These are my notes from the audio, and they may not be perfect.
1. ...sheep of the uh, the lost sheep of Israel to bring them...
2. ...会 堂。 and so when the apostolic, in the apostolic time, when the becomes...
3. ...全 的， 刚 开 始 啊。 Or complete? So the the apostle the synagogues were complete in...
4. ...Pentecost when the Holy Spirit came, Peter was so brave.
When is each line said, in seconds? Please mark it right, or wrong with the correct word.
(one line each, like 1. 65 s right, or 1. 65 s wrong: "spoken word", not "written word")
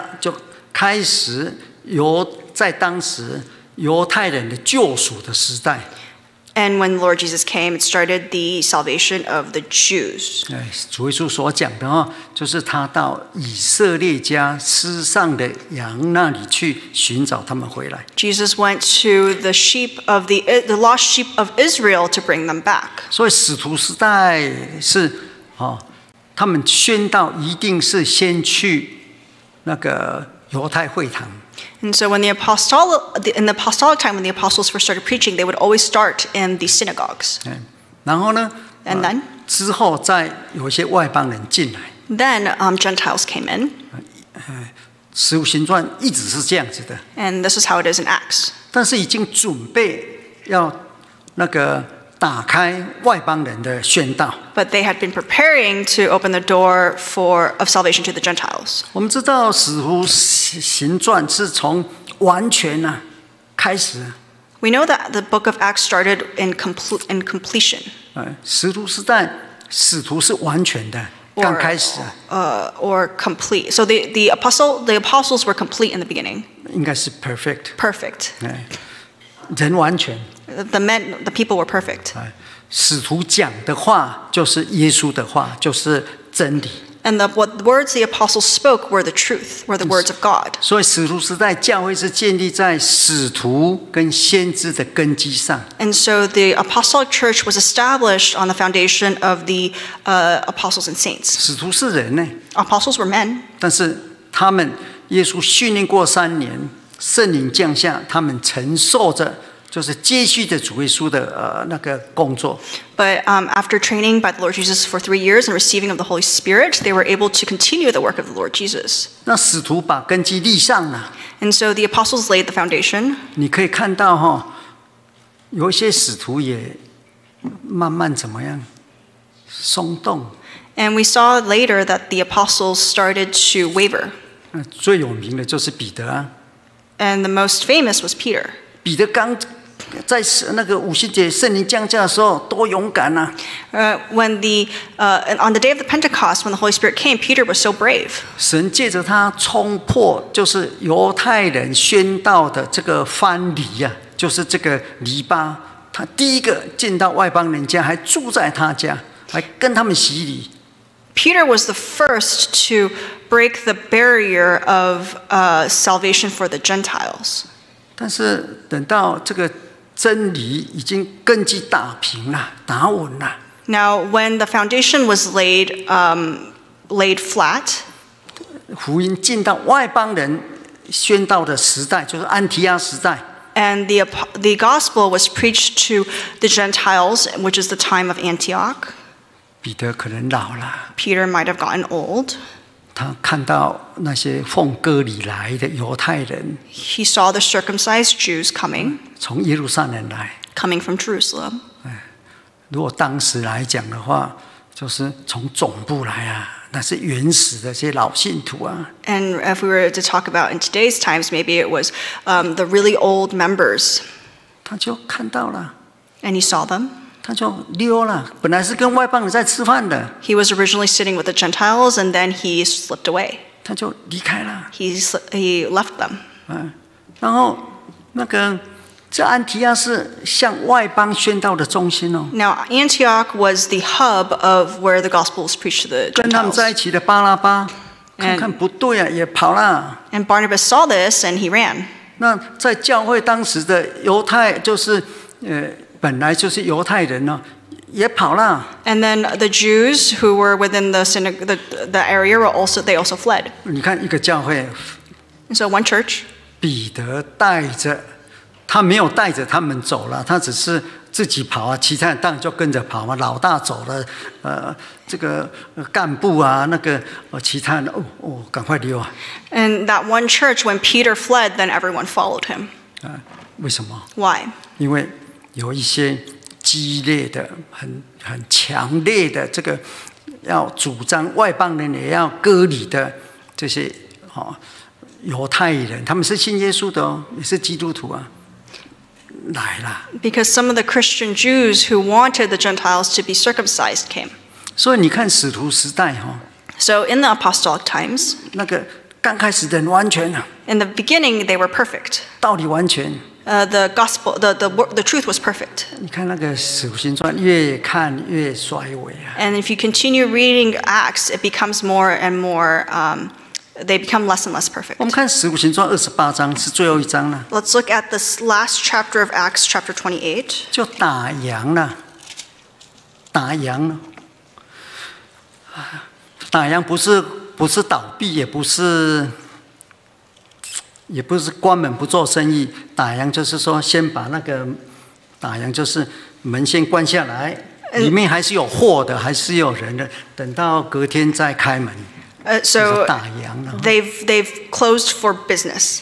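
1. 19 s right
2. 30 s wrong: "apostles", not "becomes"
3. 70 s wrong: "apostles", not "synagogues"
4. 145 s right.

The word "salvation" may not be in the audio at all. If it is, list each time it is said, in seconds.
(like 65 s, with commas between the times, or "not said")
8 s, 57 s, 165 s.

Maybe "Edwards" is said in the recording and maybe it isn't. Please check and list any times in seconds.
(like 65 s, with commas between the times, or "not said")
not said.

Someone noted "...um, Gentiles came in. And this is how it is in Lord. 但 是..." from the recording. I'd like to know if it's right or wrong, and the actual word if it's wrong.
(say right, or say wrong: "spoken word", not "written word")
wrong: "Acts", not "Lord".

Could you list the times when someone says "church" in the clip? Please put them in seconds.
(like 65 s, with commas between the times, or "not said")
97 s, 255 s, 270 s.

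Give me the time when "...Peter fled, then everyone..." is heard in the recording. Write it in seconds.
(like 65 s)
270 s.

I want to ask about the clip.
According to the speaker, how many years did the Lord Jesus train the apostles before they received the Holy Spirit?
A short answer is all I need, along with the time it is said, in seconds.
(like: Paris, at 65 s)
3, at 114 s.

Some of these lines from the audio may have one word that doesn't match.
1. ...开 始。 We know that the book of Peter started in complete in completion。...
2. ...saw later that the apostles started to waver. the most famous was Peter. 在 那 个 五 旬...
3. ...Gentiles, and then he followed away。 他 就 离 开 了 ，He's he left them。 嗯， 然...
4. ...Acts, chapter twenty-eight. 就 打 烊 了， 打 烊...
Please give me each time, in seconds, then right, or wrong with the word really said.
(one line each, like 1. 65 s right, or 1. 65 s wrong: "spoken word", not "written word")
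1. 63 s wrong: "Acts", not "Peter"
2. 131 s right
3. 221 s wrong: "slipped", not "followed"
4. 319 s right.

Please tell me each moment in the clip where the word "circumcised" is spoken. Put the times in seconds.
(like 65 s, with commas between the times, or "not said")
197 s, 293 s.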